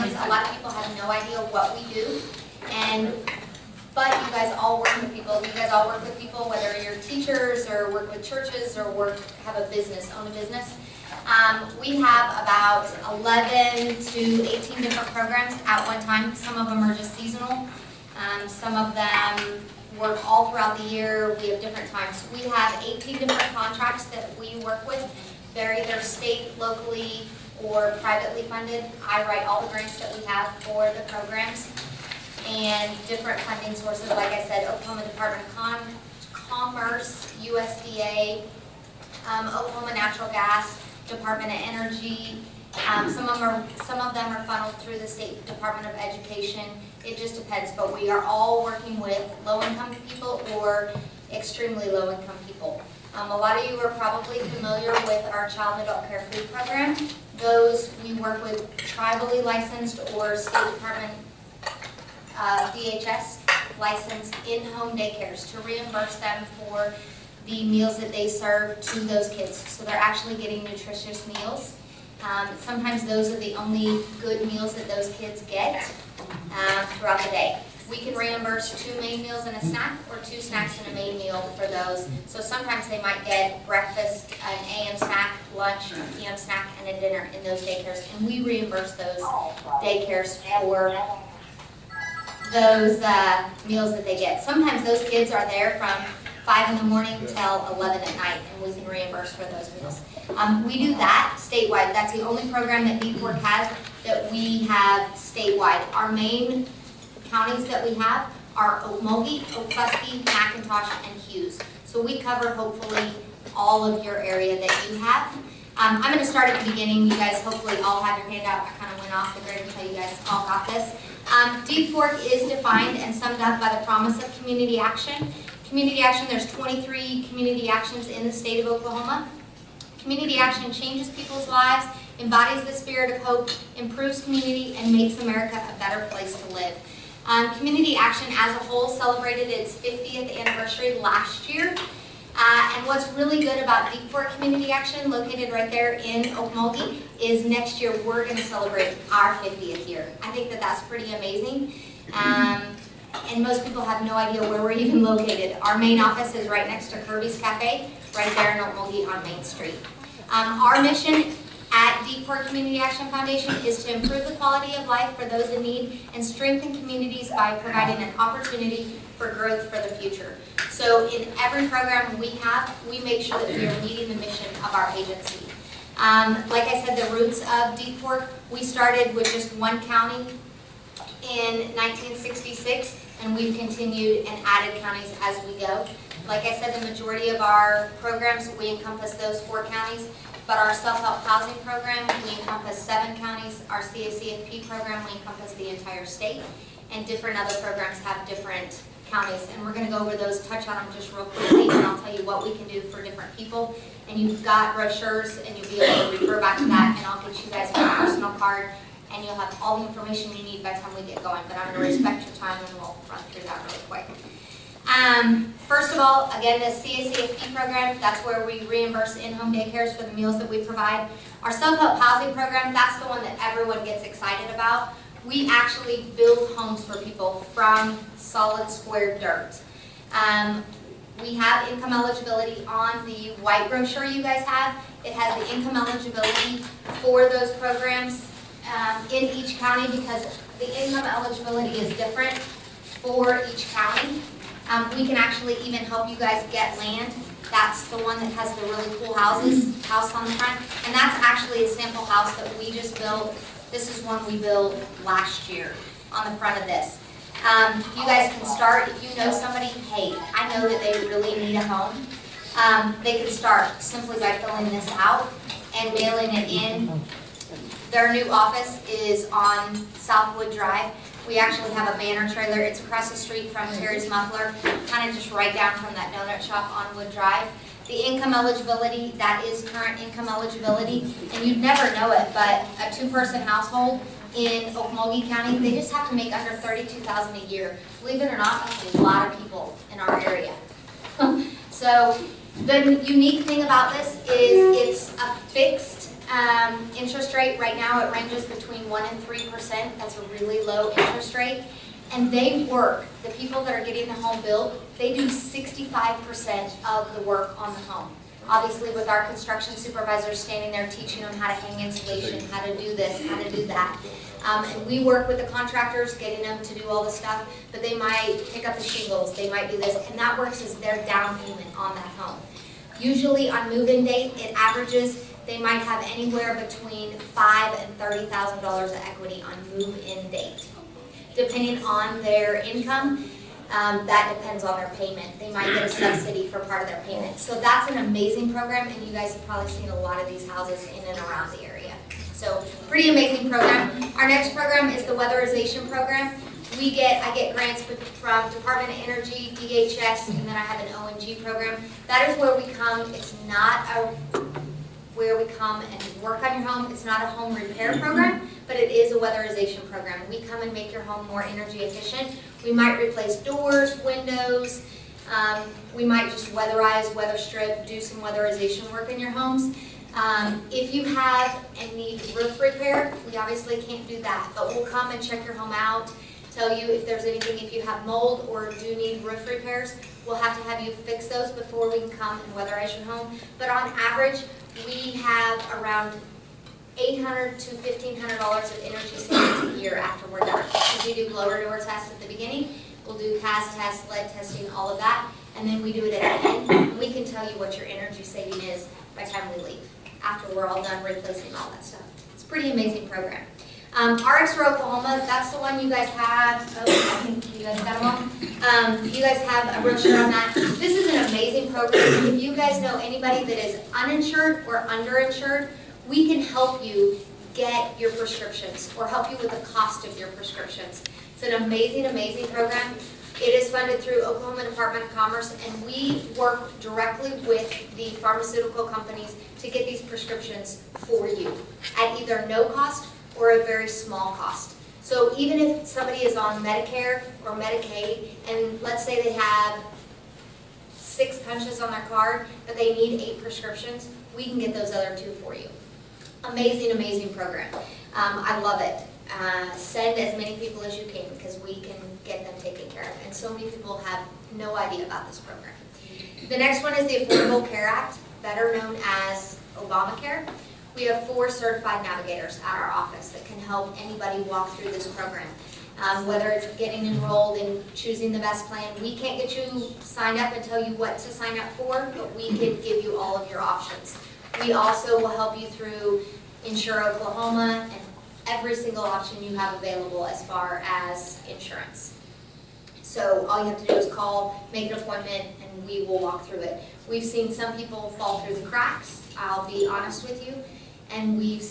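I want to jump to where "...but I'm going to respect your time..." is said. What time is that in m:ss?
3:31.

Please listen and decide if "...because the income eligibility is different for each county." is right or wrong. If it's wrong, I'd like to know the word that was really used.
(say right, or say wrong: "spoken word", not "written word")
right.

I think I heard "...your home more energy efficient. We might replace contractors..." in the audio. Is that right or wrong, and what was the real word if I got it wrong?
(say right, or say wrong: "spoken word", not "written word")
wrong: "doors", not "contractors".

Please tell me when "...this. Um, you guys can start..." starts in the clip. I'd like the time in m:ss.
4:16.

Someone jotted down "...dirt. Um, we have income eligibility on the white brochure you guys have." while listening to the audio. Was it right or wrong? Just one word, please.
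right.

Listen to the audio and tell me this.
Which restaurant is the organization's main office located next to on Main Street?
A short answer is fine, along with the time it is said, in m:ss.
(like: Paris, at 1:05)
Kirby's Cafe, at 2:37.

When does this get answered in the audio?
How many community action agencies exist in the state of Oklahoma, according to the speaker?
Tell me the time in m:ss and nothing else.
2:06.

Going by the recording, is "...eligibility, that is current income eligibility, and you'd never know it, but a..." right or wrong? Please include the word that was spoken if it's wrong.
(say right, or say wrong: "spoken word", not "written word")
right.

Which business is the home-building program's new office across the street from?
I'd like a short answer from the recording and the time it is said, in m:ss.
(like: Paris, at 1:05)
Terry's Muffler, at 4:33.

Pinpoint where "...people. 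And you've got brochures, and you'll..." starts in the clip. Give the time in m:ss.
3:23.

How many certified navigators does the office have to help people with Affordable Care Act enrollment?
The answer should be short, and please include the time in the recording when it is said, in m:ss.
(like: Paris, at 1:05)
4, at 7:41.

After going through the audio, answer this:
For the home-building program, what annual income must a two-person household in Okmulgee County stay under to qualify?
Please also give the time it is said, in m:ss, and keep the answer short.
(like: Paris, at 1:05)
32,000, at 4:46.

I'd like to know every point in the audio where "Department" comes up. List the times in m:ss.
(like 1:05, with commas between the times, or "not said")
0:35, 0:41, 0:45, 1:00, 5:47, 7:04.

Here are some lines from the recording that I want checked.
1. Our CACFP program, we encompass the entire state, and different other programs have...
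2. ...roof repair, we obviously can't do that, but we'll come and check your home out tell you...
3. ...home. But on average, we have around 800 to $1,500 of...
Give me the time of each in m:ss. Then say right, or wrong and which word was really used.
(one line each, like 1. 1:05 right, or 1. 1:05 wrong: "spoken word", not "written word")
1. 3:13 right
2. 6:12 right
3. 6:23 right.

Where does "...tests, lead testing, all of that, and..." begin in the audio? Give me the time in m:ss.
6:33.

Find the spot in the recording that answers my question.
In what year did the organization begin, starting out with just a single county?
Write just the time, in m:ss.
3:01.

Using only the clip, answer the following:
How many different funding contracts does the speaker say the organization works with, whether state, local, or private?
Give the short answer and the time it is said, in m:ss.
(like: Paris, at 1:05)
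18, at 0:22.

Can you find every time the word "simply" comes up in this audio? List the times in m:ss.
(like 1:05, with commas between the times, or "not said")
4:23.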